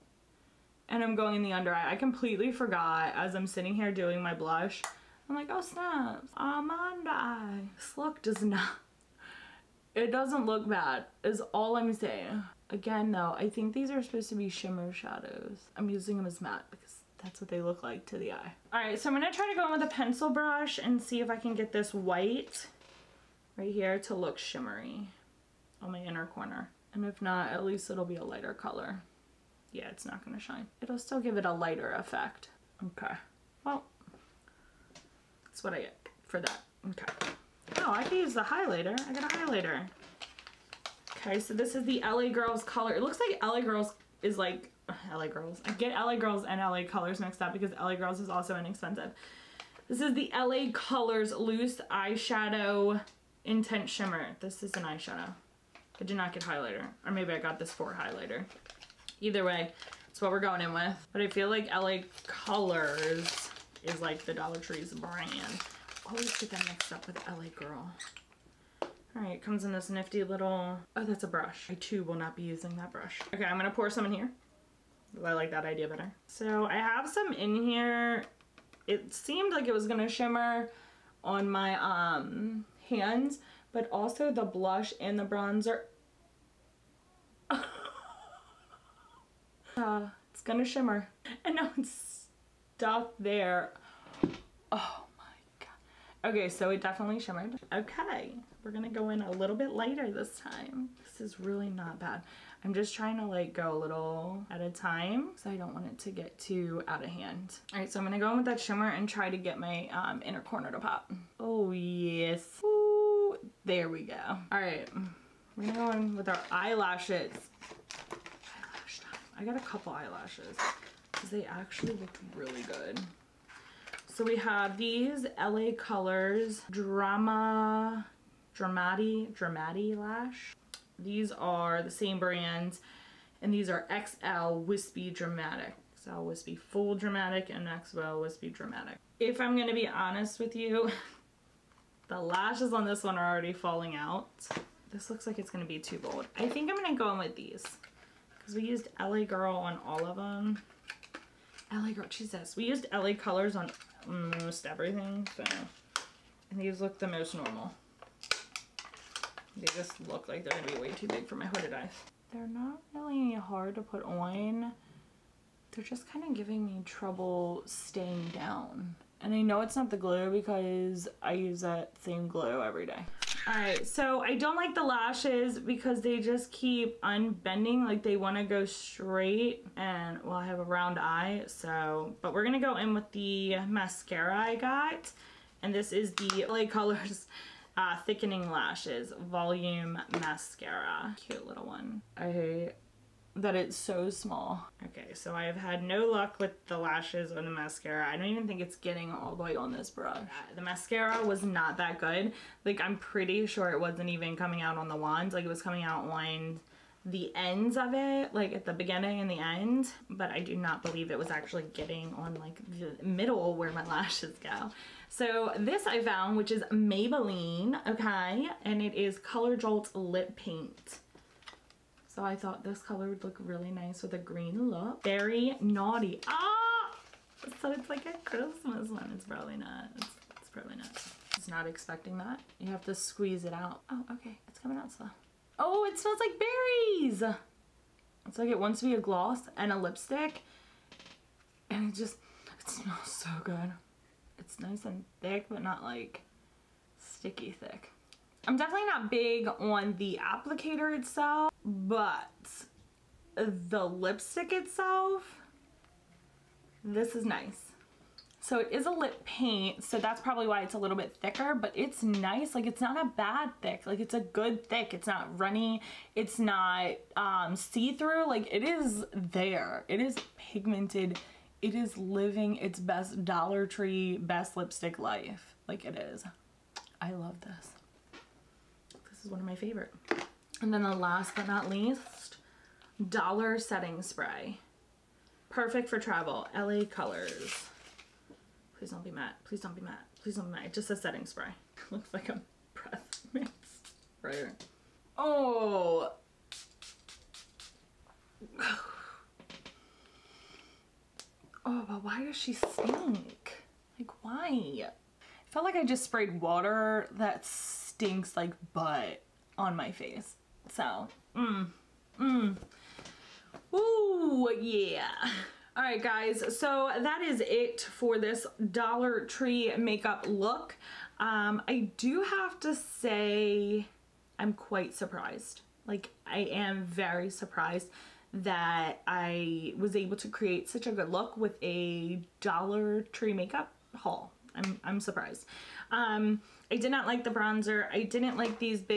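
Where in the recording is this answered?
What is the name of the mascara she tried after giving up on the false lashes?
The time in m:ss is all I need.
3:08.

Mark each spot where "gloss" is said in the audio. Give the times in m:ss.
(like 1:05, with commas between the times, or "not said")
3:59.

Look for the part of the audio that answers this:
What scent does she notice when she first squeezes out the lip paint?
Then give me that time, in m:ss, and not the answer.
3:56.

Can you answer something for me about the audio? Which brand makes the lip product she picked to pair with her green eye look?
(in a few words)
Maybelline.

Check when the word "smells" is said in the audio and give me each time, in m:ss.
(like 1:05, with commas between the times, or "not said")
3:55, 4:02.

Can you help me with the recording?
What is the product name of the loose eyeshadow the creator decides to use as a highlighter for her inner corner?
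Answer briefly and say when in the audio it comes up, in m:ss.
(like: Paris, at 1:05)
Loose Eyeshadow Intense Shimmer, at 0:51.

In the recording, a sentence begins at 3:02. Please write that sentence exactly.
But we're going to go in with the mascara I got.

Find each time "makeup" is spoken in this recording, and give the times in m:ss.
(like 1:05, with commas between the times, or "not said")
5:19, 5:33.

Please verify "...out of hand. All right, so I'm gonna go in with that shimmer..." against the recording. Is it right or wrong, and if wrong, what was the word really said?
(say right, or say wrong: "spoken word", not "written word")
right.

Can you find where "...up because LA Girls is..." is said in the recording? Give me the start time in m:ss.
0:47.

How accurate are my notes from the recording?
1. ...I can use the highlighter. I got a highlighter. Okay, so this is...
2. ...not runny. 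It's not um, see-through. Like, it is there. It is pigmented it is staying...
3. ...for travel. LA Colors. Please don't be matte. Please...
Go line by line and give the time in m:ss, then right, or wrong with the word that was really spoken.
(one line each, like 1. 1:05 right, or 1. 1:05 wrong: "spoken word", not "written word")
1. 0:37 right
2. 4:25 wrong: "living", not "staying"
3. 4:45 right.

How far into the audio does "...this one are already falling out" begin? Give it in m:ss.
2:22.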